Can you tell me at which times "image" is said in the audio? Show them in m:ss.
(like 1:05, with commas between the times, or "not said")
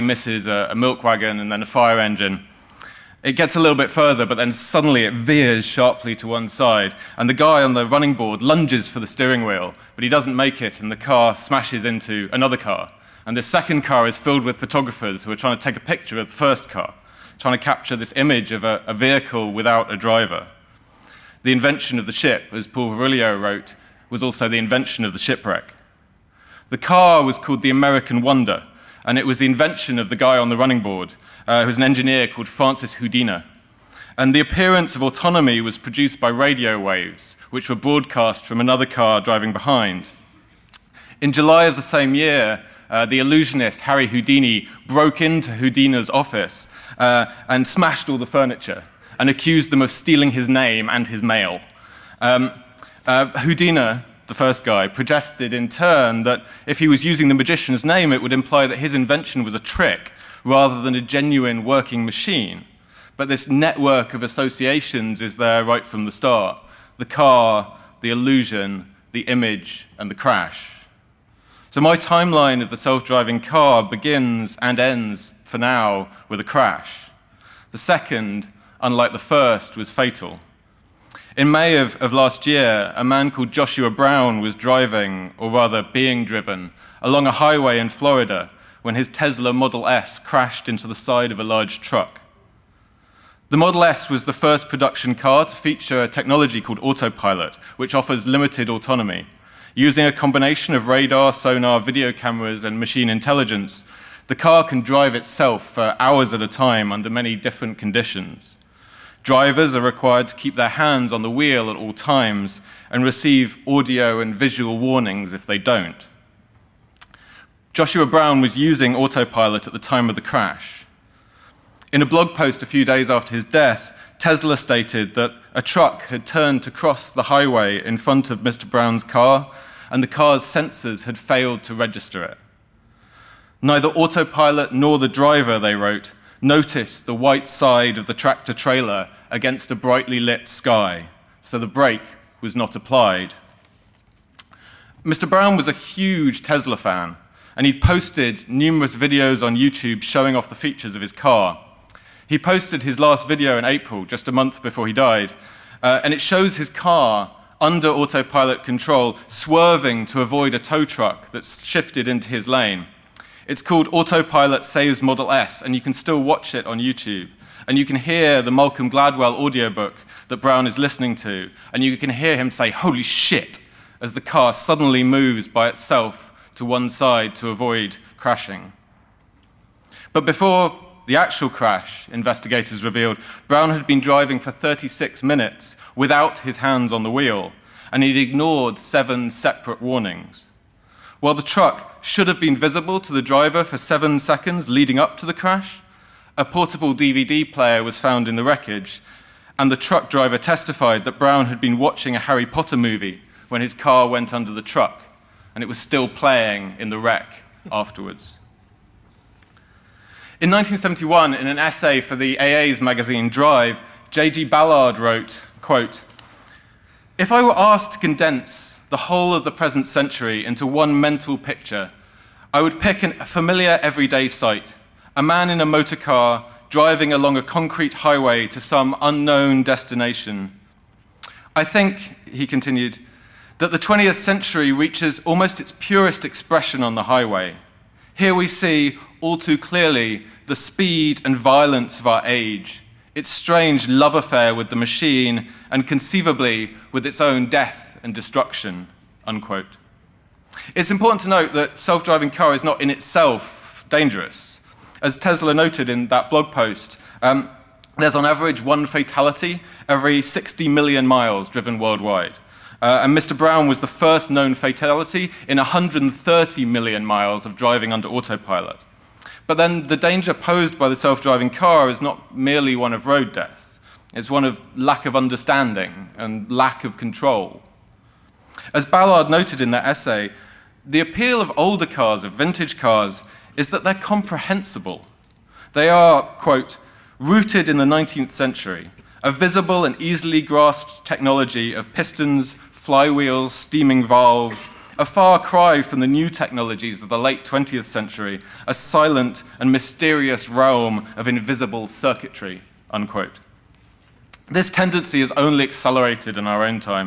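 0:18, 1:09.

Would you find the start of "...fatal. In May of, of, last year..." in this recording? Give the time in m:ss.
1:19.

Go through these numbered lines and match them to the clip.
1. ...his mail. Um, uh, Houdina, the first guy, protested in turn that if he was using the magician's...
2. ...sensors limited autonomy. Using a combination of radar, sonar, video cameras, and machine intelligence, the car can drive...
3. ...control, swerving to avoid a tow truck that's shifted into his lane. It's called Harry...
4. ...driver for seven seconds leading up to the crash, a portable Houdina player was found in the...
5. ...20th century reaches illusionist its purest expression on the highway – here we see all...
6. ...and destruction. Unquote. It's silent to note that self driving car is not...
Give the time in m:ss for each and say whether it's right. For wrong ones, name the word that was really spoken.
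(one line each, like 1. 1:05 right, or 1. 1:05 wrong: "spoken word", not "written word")
1. 0:51 right
2. 1:37 wrong: "offers", not "sensors"
3. 2:38 wrong: "Autopilot", not "Harry"
4. 3:13 wrong: "DVD", not "Houdina"
5. 3:53 wrong: "almost", not "illusionist"
6. 4:08 wrong: "important", not "silent".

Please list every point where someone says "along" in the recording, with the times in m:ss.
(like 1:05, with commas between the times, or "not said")
1:27, 3:47.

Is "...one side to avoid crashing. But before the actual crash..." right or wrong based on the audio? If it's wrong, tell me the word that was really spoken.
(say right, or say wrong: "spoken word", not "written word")
right.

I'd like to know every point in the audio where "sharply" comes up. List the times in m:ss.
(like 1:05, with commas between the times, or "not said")
0:05.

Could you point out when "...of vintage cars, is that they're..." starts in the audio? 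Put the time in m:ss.
4:42.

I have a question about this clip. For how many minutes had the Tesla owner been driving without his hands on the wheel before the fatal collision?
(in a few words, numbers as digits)
36.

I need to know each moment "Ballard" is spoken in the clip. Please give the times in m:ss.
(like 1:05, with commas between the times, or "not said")
3:34, 4:38.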